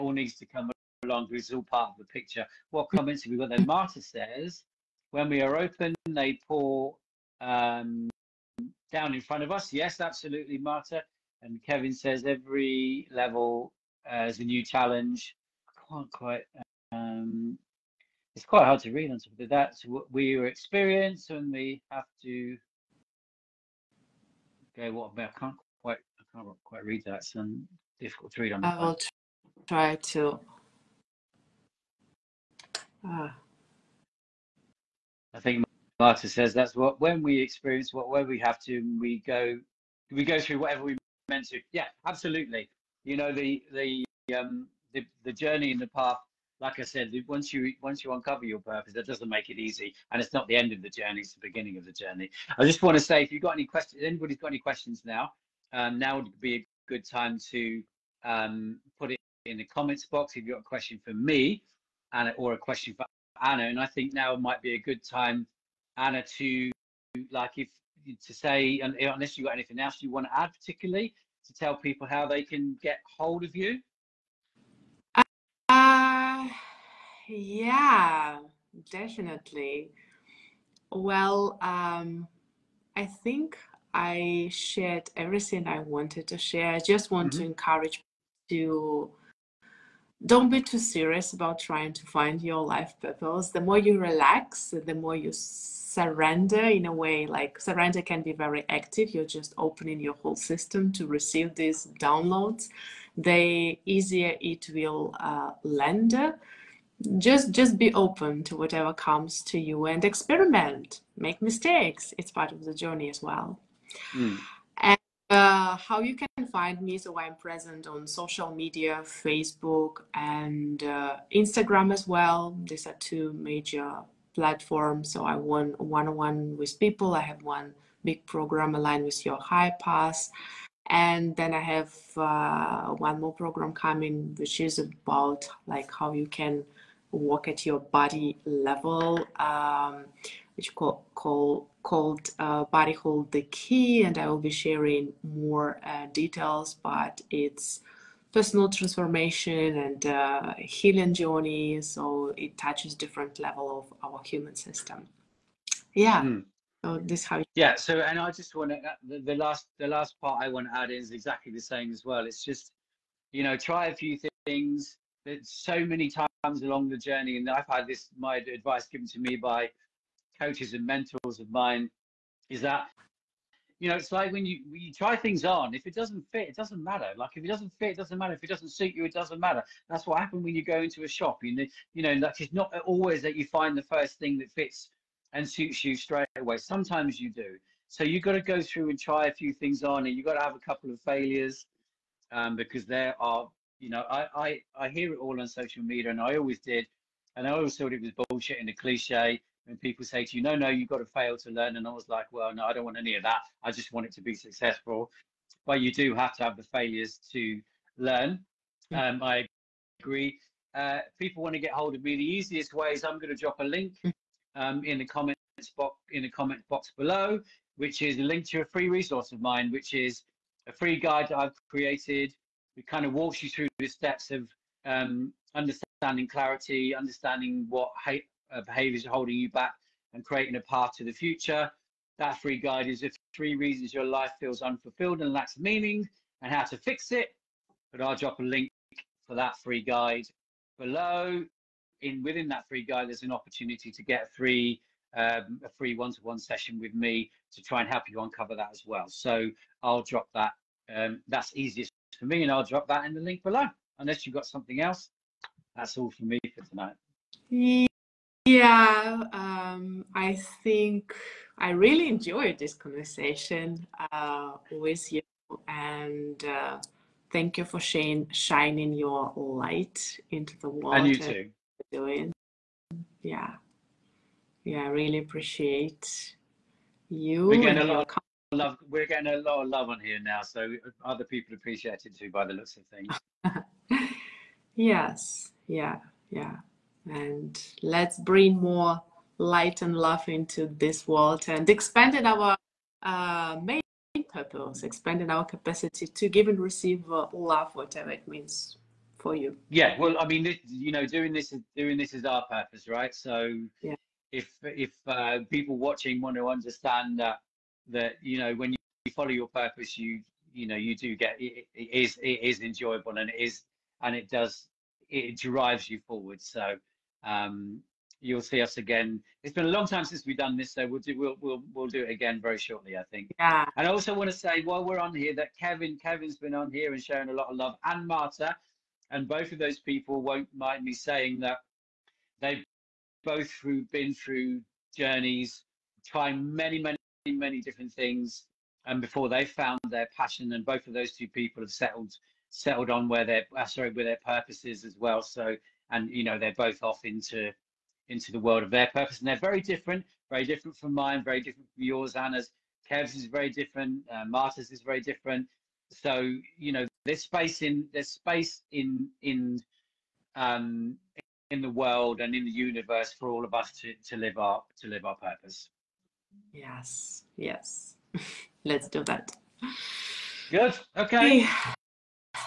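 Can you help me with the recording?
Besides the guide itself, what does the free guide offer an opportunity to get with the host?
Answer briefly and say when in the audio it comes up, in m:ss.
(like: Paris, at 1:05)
a free one-to-one session, at 4:05.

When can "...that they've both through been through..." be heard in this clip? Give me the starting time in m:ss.
5:31.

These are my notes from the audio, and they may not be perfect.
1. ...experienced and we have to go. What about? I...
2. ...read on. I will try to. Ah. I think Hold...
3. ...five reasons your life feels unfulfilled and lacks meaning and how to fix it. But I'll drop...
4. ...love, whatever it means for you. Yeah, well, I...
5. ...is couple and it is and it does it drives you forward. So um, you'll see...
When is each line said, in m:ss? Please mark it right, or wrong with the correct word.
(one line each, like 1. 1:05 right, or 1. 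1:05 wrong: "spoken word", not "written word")
1. 0:20 right
2. 0:28 wrong: "Marta", not "Hold"
3. 3:53 wrong: "three", not "five"
4. 4:57 right
5. 5:12 wrong: "enjoyable", not "couple".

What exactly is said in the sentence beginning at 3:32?
The easiest way is I'm going to drop a link hmm.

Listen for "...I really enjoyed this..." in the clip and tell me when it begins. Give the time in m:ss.
4:21.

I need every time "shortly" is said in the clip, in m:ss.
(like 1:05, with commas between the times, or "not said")
5:22.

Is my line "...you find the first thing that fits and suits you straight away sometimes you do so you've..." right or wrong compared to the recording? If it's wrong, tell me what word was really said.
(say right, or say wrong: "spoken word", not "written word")
right.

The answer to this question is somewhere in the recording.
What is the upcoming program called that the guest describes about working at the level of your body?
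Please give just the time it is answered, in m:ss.
2:22.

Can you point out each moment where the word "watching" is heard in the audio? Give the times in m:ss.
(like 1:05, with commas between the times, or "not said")
5:05.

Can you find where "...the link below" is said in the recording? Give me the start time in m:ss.
4:13.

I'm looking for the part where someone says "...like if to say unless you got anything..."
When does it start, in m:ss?
1:07.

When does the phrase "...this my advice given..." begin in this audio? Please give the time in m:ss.
2:47.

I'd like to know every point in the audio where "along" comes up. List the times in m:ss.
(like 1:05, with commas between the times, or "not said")
0:01, 2:46.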